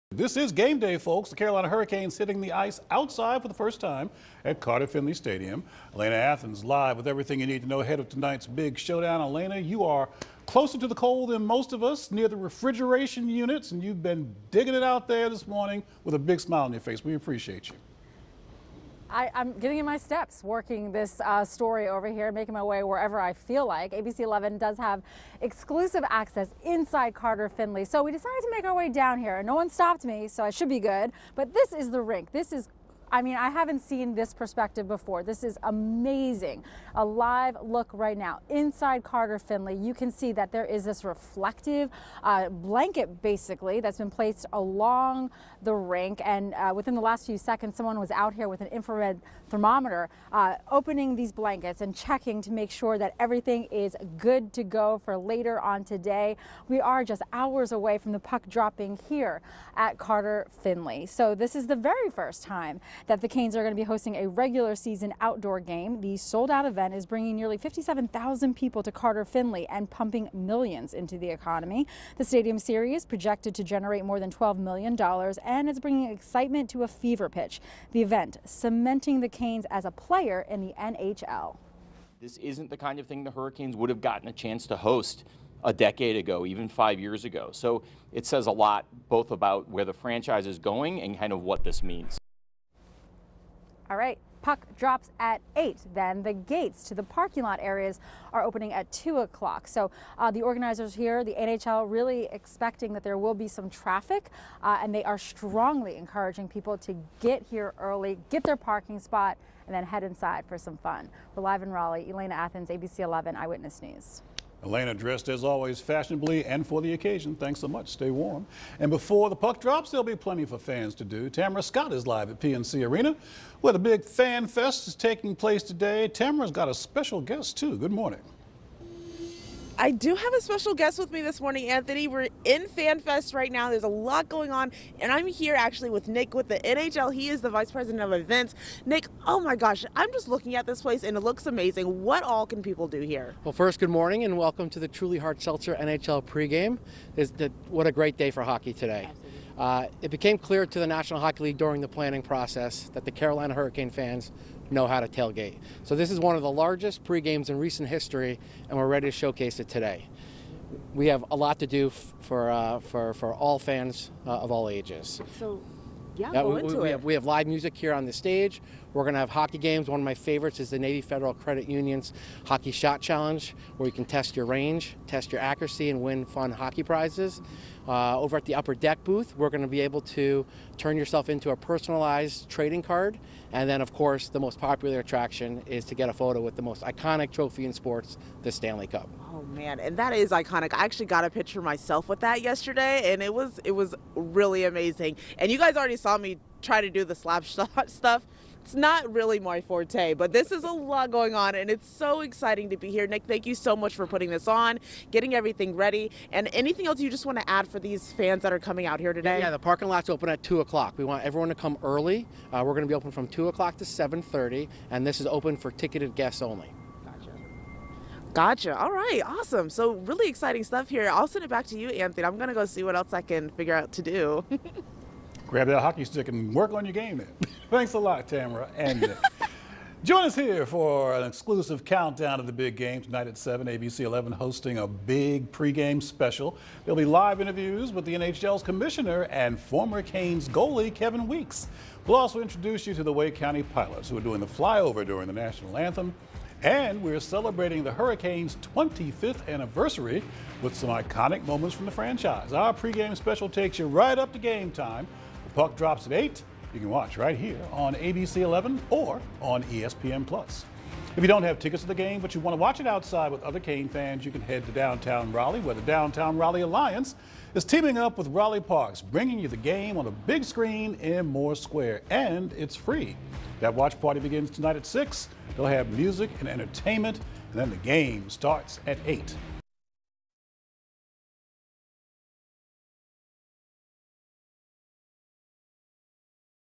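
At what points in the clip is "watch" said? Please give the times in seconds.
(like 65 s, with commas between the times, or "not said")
256 s, 262 s, 273 s.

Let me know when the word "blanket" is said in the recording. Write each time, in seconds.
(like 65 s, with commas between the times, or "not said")
42 s, 51 s.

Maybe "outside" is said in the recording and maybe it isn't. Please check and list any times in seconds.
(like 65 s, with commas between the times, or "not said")
2 s, 262 s.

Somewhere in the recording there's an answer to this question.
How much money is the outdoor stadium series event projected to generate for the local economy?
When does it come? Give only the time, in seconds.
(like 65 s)
74 s.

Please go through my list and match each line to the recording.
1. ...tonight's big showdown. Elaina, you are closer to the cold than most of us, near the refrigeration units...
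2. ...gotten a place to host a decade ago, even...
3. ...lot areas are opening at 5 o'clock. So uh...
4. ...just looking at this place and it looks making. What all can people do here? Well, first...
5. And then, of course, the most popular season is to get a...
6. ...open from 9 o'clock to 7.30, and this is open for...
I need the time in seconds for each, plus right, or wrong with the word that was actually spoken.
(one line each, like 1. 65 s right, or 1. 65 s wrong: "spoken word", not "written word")
1. 8 s right
2. 84 s wrong: "chance", not "place"
3. 97 s wrong: "2", not "5"
4. 140 s wrong: "amazing", not "making"
5. 183 s wrong: "attraction", not "season"
6. 212 s wrong: "2", not "9".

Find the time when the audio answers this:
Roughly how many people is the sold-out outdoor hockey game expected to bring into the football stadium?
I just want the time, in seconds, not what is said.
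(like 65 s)
67 s.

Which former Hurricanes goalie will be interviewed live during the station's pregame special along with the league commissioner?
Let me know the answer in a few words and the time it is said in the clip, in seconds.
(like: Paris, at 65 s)
Kevin Weekes, at 240 s.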